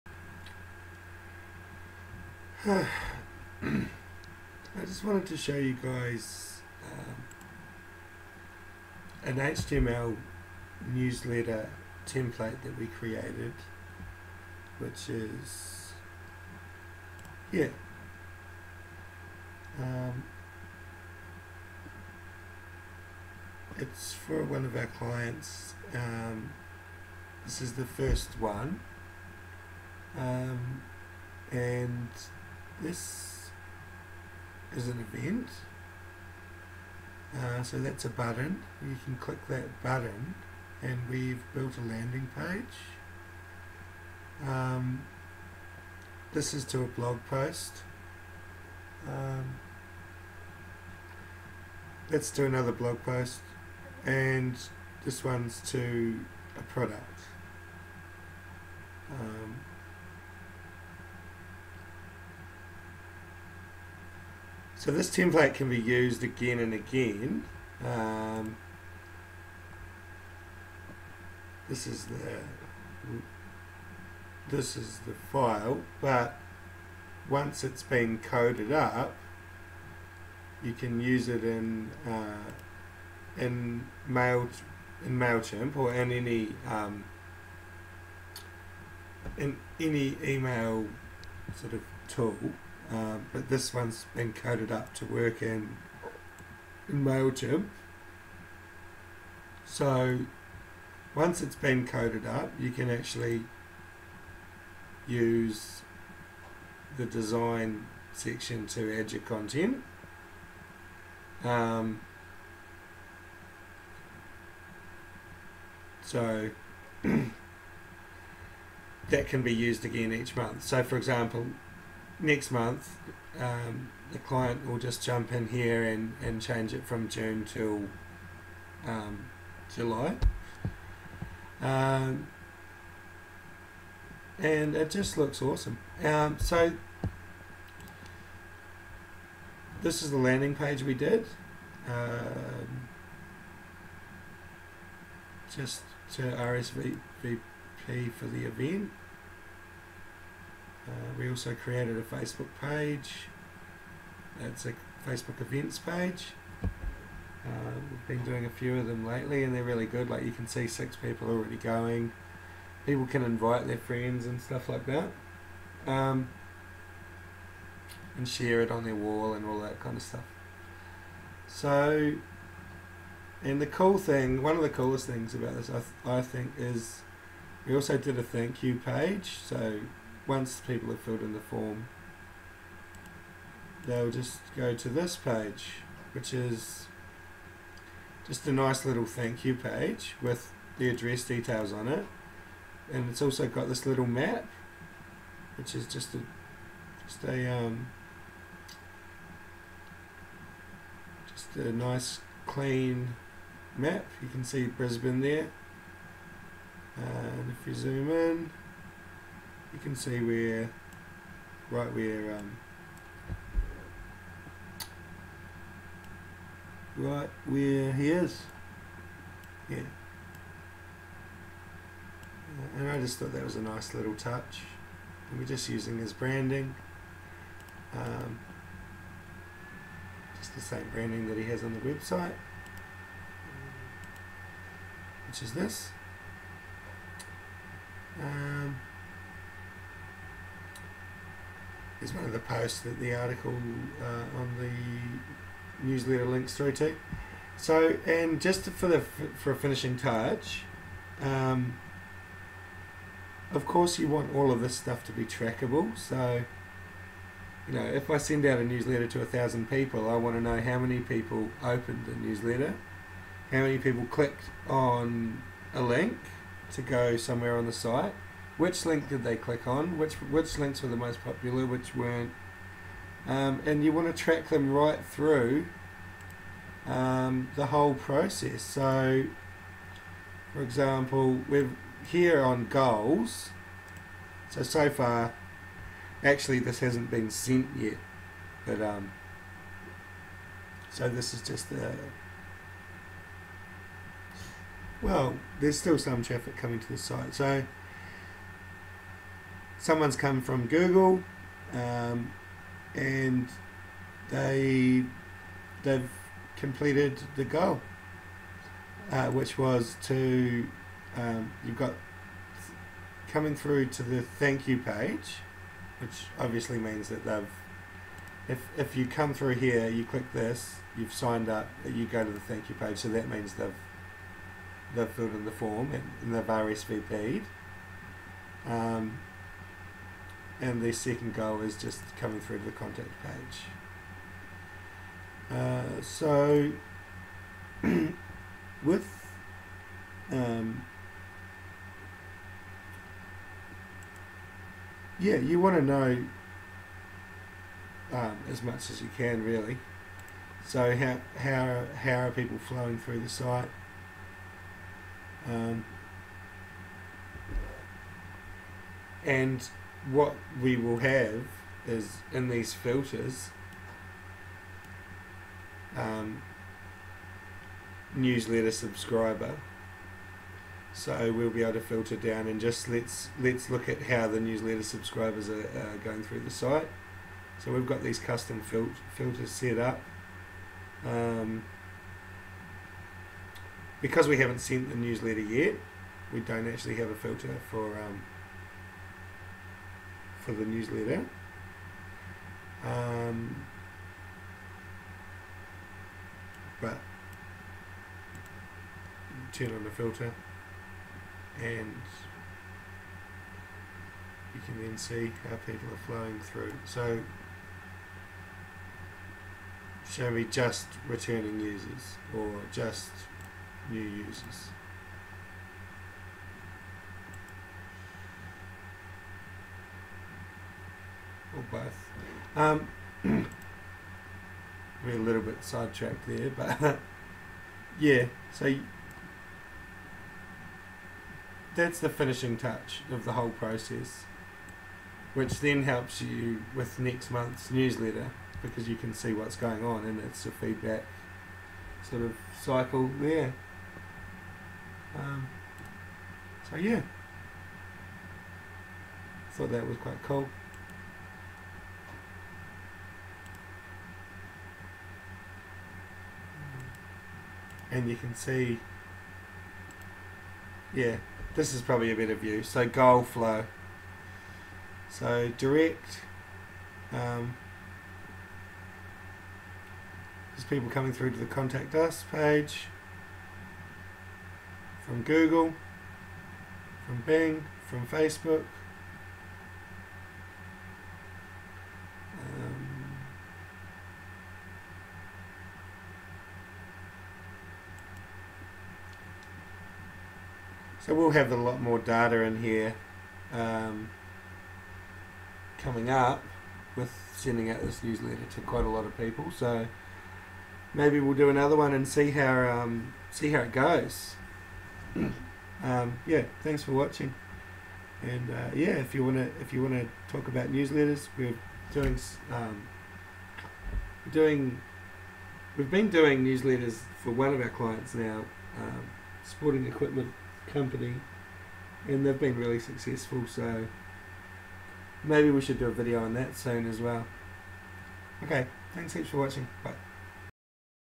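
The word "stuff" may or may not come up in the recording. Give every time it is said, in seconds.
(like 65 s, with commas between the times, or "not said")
164 s, 170 s, 254 s.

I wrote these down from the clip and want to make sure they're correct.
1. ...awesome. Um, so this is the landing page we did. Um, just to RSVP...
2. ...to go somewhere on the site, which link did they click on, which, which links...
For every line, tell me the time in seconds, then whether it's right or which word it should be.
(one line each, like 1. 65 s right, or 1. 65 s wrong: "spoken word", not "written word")
1. 135 s right
2. 266 s right.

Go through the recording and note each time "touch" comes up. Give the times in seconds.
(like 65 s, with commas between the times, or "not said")
224 s, 249 s, 432 s.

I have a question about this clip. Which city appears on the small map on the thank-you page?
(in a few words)
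Brisbane.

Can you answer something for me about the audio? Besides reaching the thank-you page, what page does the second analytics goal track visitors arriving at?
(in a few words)
contact page.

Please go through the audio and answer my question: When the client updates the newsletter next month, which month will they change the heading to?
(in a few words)
July.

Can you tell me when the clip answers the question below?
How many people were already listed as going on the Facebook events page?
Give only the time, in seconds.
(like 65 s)
160 s.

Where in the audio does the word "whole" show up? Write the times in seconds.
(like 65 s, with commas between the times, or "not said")
277 s, 433 s.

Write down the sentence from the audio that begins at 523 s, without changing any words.
So maybe we should do a video on that soon as well.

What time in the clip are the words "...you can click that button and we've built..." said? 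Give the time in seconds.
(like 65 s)
38 s.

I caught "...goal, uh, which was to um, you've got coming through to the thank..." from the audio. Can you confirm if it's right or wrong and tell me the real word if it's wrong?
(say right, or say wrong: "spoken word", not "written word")
right.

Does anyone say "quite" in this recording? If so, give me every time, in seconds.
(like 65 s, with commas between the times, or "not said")
449 s, 498 s.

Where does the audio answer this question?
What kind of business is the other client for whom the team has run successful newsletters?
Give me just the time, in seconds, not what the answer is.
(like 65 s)
519 s.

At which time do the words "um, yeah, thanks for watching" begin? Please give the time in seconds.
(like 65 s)
505 s.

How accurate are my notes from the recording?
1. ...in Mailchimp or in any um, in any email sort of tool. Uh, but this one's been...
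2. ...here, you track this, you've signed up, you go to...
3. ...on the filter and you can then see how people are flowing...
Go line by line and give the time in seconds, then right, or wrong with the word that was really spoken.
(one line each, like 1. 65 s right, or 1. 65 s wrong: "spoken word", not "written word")
1. 85 s right
2. 319 s wrong: "click", not "track"
3. 399 s right.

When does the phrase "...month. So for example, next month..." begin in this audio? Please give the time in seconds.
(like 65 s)
120 s.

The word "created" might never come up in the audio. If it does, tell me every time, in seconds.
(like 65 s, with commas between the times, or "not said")
12 s, 151 s.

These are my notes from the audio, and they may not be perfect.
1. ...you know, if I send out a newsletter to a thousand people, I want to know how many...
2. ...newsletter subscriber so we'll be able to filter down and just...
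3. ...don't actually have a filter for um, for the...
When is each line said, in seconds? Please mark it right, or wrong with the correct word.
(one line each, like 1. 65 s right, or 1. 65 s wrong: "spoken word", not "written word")
1. 257 s right
2. 368 s right
3. 386 s right.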